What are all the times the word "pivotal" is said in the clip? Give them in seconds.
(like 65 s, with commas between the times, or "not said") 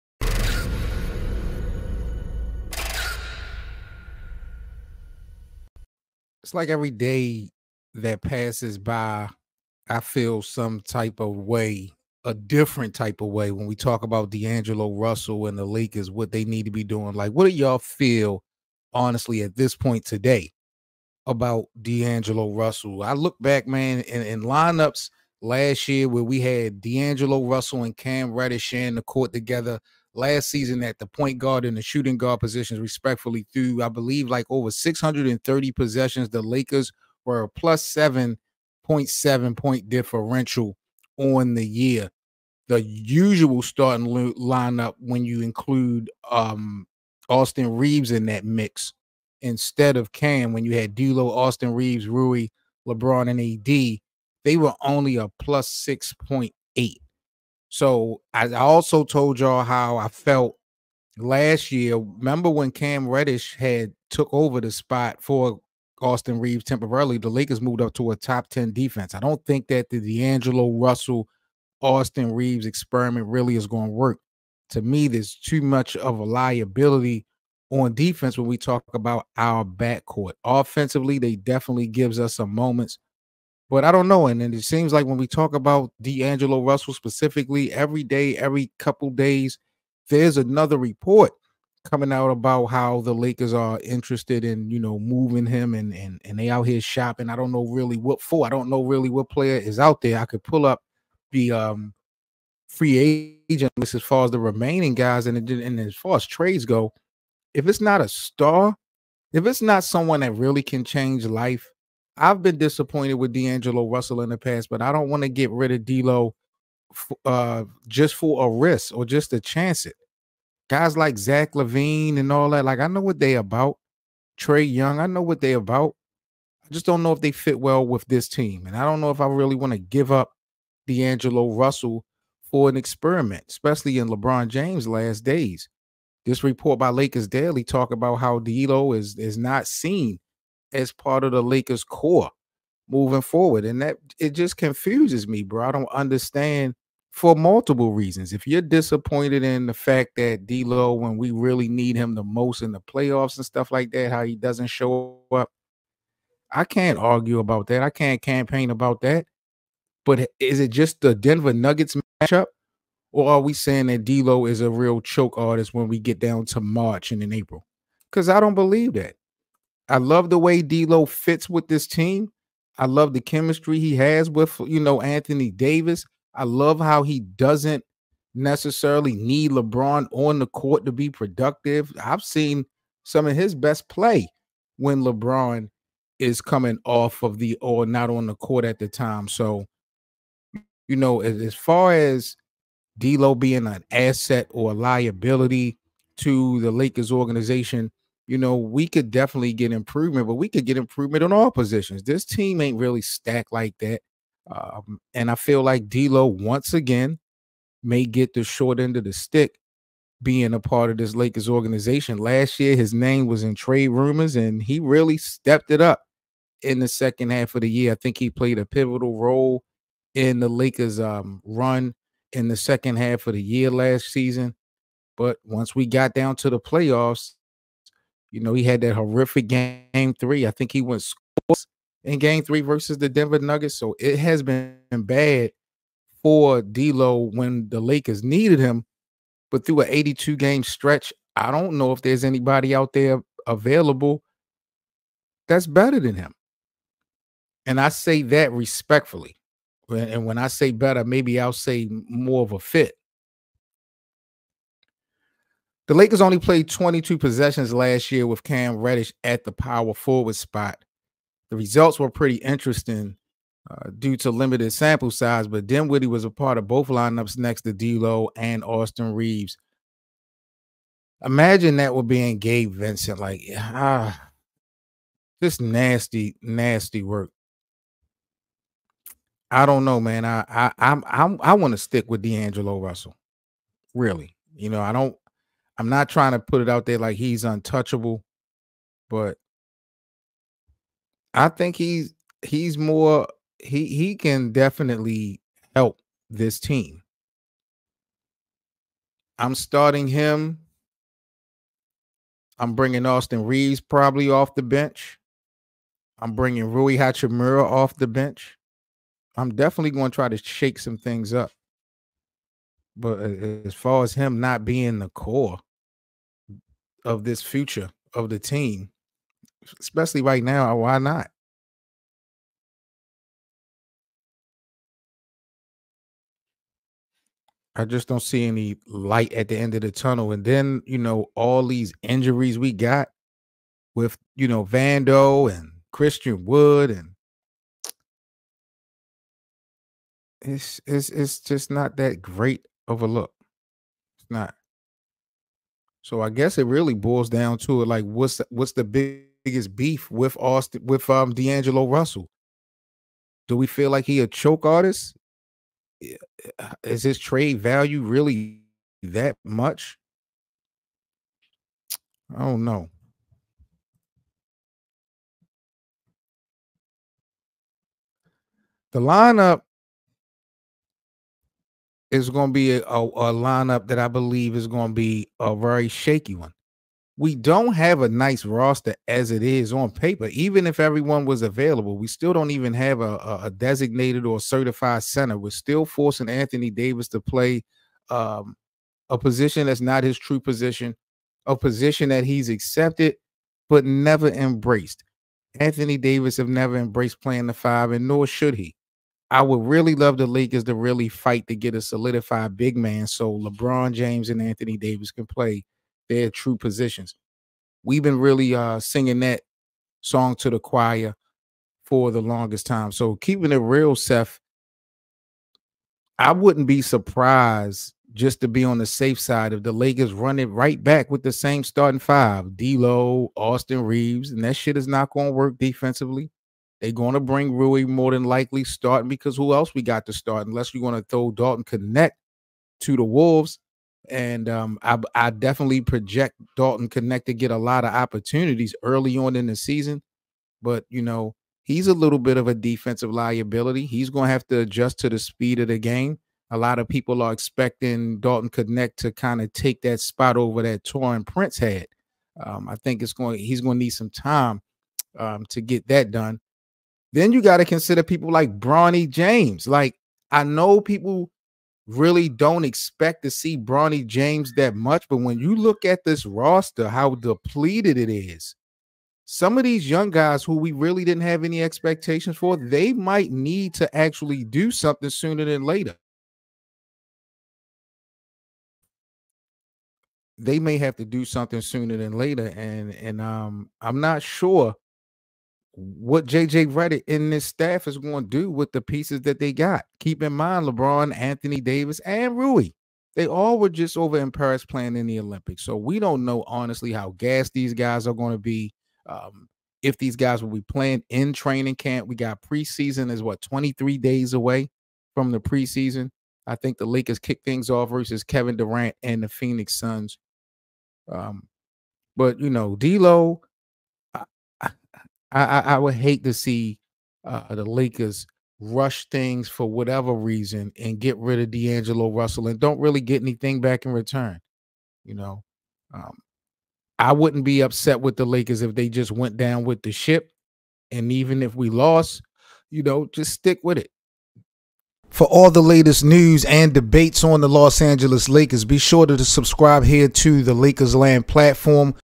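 218 s.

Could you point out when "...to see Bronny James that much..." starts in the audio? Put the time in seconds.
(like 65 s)
463 s.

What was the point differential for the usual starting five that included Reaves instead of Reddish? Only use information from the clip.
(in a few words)
plus 6.8.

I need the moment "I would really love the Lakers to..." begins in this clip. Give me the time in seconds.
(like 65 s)
399 s.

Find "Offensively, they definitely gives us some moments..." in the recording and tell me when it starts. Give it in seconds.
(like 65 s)
80 s.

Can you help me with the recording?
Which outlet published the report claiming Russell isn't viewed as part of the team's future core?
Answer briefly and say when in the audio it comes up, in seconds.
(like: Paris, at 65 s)
Lakers Daily, at 136 s.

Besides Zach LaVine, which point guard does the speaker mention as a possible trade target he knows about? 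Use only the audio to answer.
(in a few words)
Trae Young.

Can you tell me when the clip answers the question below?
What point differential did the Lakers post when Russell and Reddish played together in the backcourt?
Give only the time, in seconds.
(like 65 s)
37 s.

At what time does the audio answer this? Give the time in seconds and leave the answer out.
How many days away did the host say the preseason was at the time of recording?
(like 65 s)
503 s.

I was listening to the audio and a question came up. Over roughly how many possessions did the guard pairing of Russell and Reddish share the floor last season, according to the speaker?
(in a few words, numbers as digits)
630.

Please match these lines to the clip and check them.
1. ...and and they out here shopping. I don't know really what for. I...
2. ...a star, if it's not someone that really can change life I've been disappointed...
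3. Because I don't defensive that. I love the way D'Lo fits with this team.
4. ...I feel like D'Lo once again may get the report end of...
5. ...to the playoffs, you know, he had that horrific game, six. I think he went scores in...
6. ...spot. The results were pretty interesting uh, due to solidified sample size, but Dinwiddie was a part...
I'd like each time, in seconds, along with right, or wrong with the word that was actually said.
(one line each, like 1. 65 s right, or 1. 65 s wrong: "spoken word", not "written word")
1. 95 s right
2. 108 s right
3. 168 s wrong: "believe", not "defensive"
4. 205 s wrong: "short", not "report"
5. 226 s wrong: "three", not "six"
6. 260 s wrong: "limited", not "solidified".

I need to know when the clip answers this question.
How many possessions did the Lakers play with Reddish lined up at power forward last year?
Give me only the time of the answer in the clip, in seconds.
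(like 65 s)
256 s.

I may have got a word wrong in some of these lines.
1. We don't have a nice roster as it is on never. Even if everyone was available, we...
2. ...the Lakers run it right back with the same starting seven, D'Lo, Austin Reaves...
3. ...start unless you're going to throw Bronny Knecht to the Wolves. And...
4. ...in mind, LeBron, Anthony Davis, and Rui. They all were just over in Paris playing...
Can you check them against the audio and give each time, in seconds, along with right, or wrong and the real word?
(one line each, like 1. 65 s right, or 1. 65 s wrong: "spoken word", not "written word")
1. 377 s wrong: "paper", not "never"
2. 419 s wrong: "five", not "seven"
3. 430 s wrong: "Dalton", not "Bronny"
4. 490 s right.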